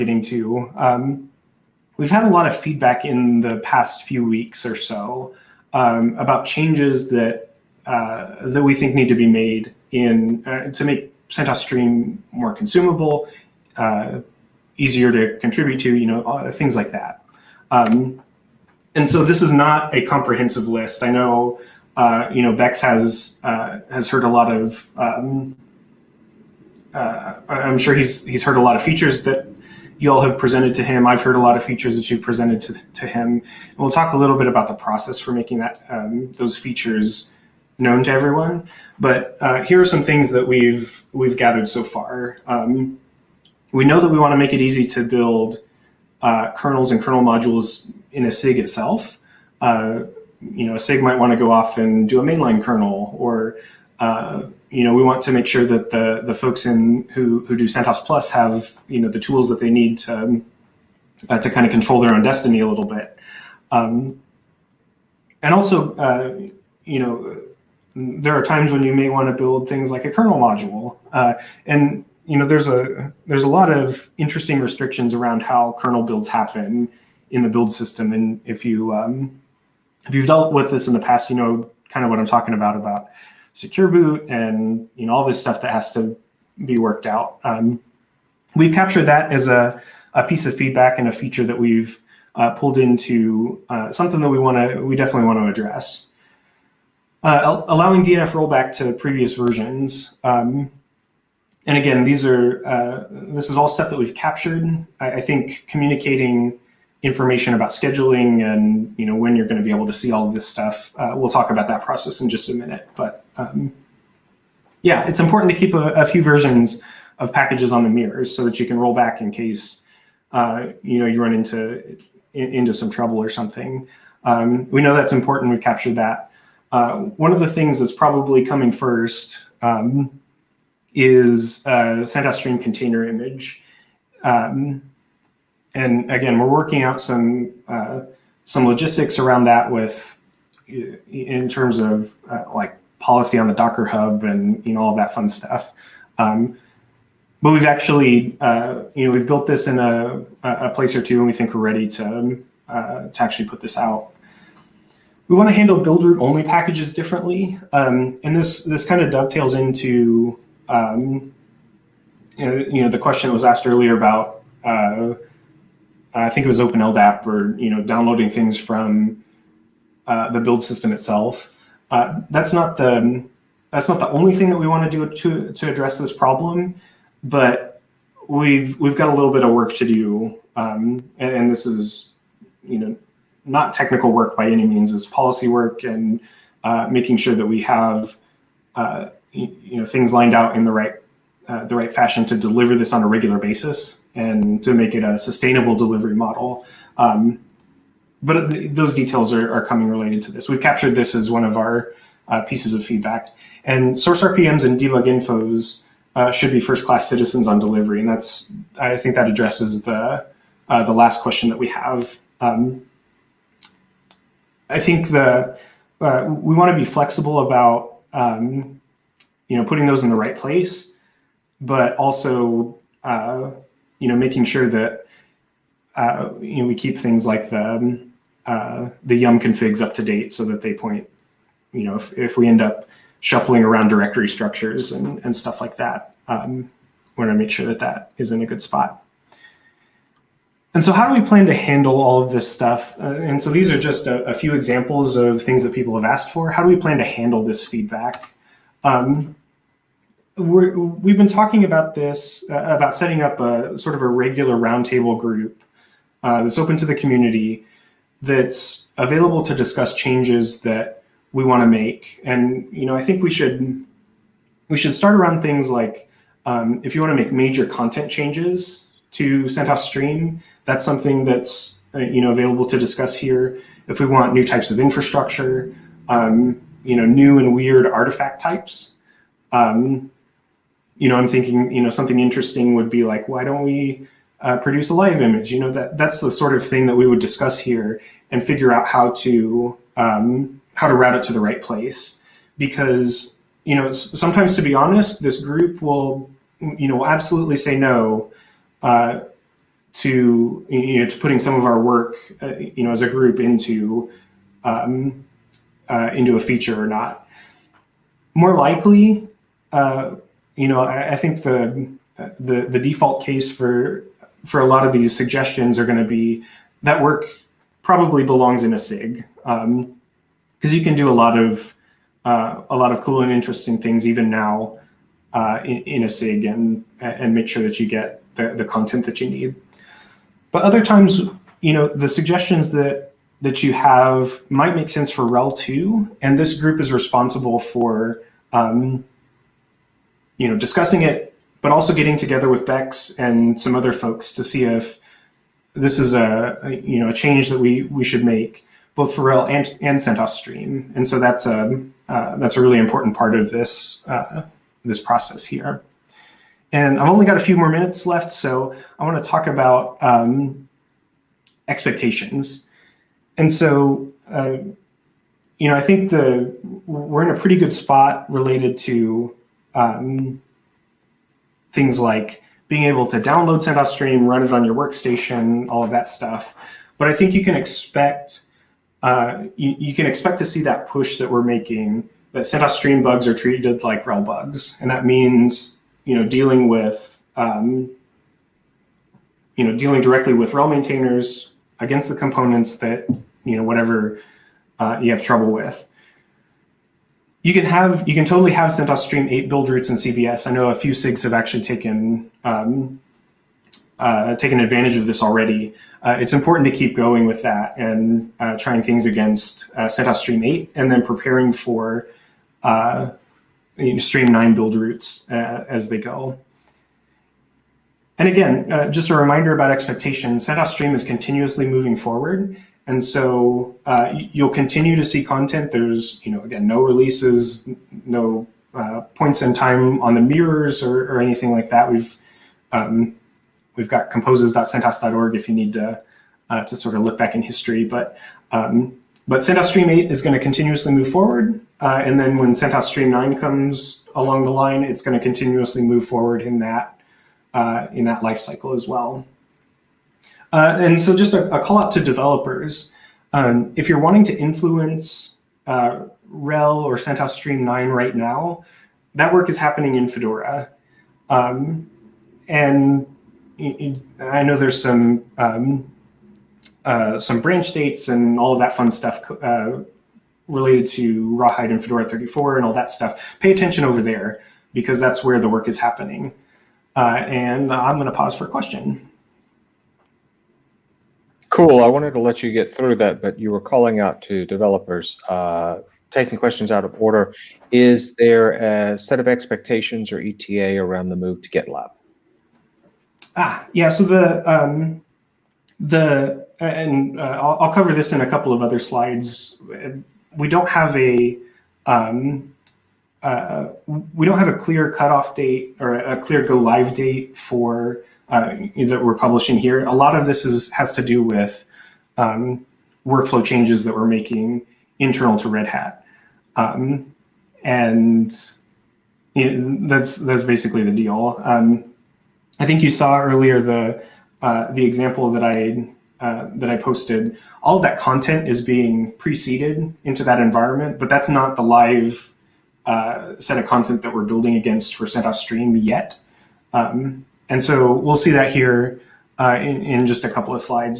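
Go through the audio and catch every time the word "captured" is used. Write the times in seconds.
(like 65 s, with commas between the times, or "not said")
88 s, 104 s, 125 s, 200 s.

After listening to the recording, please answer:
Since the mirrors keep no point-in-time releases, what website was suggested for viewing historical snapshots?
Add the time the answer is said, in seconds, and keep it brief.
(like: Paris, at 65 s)
composes.centos.org, at 434 s.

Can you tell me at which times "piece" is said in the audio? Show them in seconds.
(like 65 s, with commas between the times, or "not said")
90 s, 202 s.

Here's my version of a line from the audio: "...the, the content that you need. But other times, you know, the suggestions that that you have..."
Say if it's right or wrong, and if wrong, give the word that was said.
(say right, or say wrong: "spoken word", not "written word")
right.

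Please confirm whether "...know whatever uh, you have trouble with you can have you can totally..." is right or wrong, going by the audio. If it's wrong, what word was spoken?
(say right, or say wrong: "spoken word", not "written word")
right.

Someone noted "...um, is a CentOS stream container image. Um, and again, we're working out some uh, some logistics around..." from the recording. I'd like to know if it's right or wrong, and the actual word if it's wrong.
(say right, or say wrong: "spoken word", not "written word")
right.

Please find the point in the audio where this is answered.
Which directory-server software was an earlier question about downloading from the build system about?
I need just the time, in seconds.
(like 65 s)
166 s.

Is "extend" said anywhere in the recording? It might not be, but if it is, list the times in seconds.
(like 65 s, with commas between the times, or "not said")
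not said.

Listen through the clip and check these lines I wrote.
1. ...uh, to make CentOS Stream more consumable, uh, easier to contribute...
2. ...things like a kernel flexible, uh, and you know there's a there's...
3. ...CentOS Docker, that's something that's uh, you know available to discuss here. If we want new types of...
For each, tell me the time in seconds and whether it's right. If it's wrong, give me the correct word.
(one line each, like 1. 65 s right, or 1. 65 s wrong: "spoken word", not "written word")
1. 10 s right
2. 69 s wrong: "module", not "flexible"
3. 269 s wrong: "Stream", not "Docker".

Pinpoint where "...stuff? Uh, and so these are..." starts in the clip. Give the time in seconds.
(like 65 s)
242 s.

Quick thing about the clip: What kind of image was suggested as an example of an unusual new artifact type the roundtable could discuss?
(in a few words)
A live image.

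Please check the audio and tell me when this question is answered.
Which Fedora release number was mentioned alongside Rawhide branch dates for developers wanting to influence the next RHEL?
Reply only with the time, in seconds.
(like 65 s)
471 s.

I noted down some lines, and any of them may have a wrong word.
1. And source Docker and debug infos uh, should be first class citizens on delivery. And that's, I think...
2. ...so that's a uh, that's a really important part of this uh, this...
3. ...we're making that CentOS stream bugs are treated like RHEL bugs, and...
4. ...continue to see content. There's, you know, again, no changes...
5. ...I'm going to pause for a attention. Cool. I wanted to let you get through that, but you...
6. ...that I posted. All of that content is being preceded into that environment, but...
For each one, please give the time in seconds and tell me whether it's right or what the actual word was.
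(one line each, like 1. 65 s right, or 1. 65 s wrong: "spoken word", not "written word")
1. 203 s wrong: "RPMs", not "Docker"
2. 351 s right
3. 381 s right
4. 424 s wrong: "releases", not "changes"
5. 477 s wrong: "question", not "attention"
6. 526 s right.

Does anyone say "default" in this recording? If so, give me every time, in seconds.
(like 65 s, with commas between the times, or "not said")
312 s.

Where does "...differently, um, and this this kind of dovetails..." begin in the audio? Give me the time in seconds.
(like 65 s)
156 s.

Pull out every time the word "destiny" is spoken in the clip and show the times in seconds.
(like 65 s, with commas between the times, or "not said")
62 s.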